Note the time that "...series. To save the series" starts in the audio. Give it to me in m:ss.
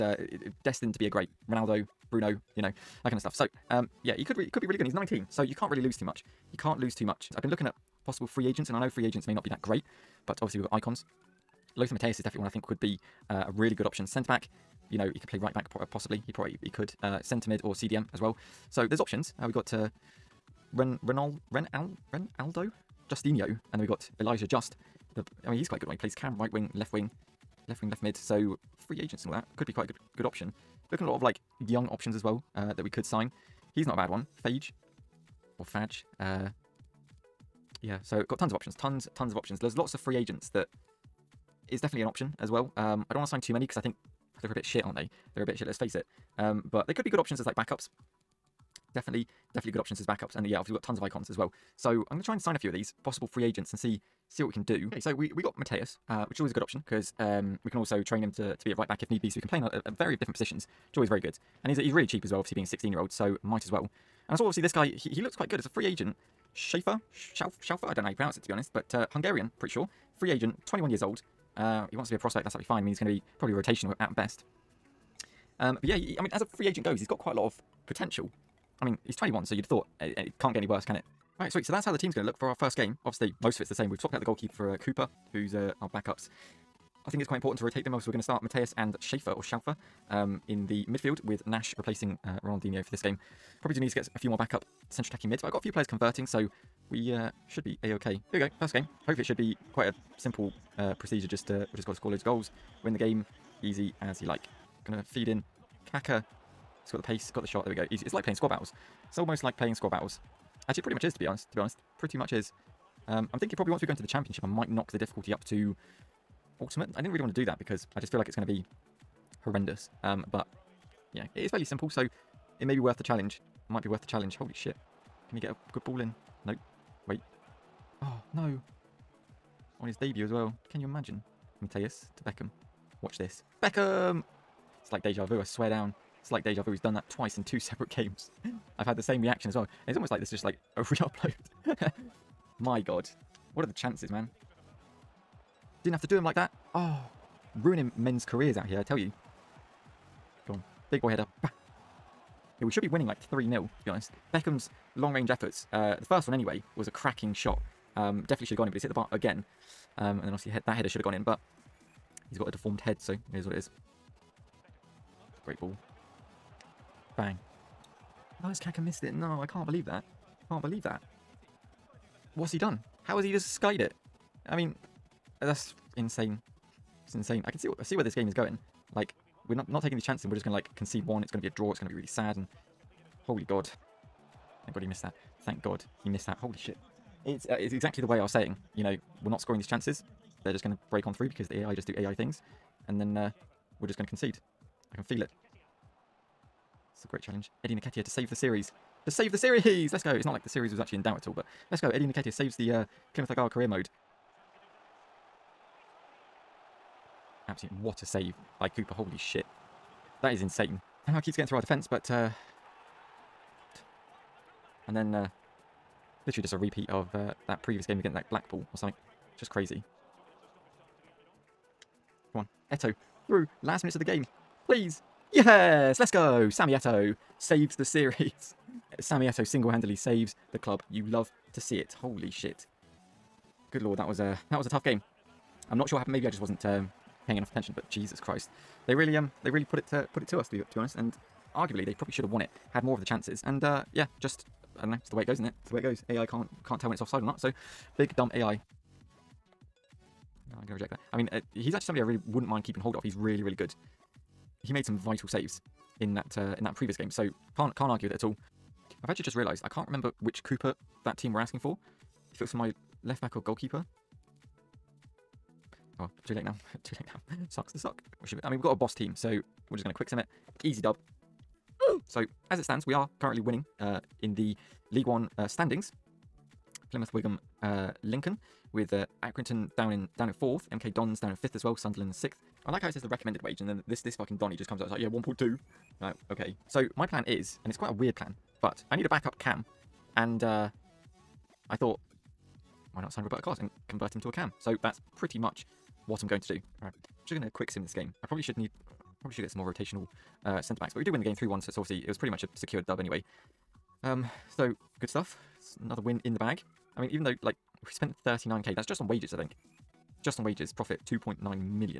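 3:18.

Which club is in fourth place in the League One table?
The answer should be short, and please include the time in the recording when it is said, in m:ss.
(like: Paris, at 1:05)
Accrington, at 4:39.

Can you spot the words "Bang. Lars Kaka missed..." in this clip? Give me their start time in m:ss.
2:47.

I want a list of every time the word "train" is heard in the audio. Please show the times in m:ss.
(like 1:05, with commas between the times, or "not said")
0:58.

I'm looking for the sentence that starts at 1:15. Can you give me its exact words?
Um, but yeah, he, I mean, as a free agent goes, he's got quite a lot of potential.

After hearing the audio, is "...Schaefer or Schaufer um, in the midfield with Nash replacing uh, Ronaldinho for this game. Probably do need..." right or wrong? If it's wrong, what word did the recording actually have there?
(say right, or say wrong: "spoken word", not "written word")
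right.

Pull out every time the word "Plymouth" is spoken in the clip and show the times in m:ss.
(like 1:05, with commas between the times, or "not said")
3:23, 4:36.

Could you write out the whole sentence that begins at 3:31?
Somehow keeps getting through our defence, but...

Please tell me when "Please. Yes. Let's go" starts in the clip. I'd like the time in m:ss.
3:44.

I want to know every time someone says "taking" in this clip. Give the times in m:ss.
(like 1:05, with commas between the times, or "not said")
2:59.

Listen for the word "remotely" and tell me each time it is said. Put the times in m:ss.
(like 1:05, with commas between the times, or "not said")
not said.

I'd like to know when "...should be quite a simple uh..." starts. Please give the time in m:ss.
1:39.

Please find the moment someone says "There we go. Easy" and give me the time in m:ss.
1:47.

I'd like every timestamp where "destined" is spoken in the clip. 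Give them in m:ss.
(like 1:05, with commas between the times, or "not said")
0:00.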